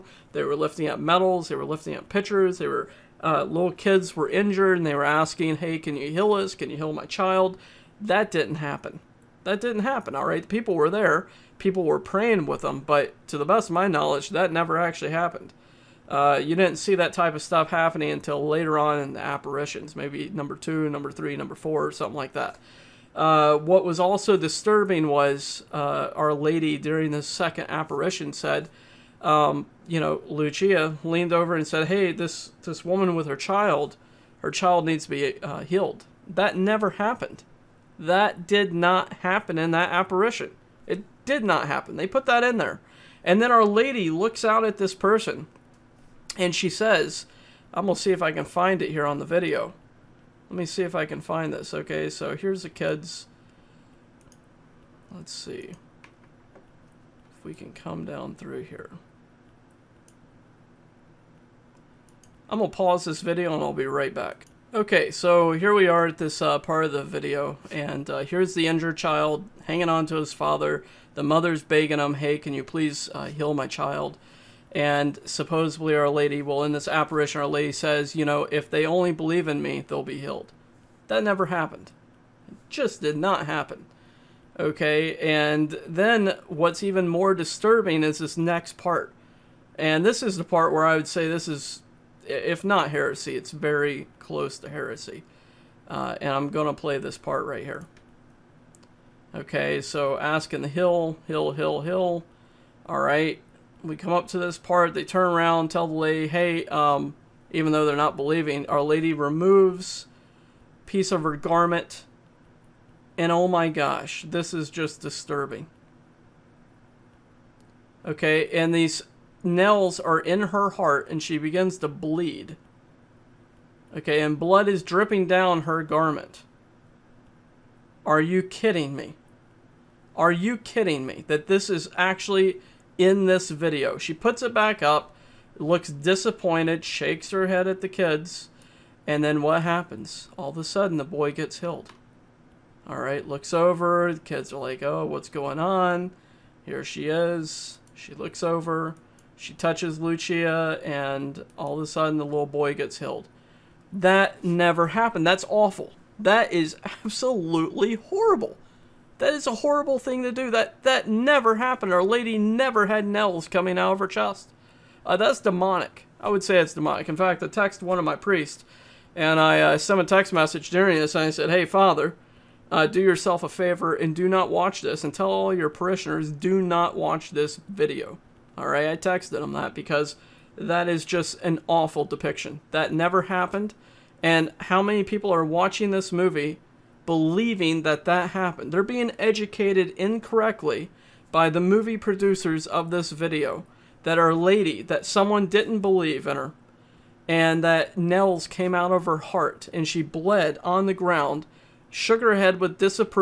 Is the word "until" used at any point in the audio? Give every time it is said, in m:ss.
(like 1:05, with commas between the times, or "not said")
0:18.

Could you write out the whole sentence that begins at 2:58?
All right, I texted them that because that is just an awful depiction.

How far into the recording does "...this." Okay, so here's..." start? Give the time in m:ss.
0:51.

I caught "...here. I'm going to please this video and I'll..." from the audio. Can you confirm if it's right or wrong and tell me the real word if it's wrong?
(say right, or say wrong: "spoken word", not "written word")
wrong: "pause", not "please".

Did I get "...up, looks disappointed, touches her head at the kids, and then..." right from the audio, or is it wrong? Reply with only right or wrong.
wrong.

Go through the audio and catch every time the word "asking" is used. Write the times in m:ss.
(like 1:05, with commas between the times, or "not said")
0:05, 1:40.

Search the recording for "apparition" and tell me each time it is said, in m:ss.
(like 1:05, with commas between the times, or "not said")
0:19, 0:27, 0:39, 1:16.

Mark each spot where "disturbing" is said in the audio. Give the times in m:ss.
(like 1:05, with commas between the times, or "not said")
0:24, 1:27, 1:54.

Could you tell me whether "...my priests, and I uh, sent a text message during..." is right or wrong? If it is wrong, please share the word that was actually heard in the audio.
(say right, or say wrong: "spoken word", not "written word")
right.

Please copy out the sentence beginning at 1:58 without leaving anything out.
Okay, and these nails are in her heart and she begins to bleed.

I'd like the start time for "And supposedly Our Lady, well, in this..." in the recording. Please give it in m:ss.
1:14.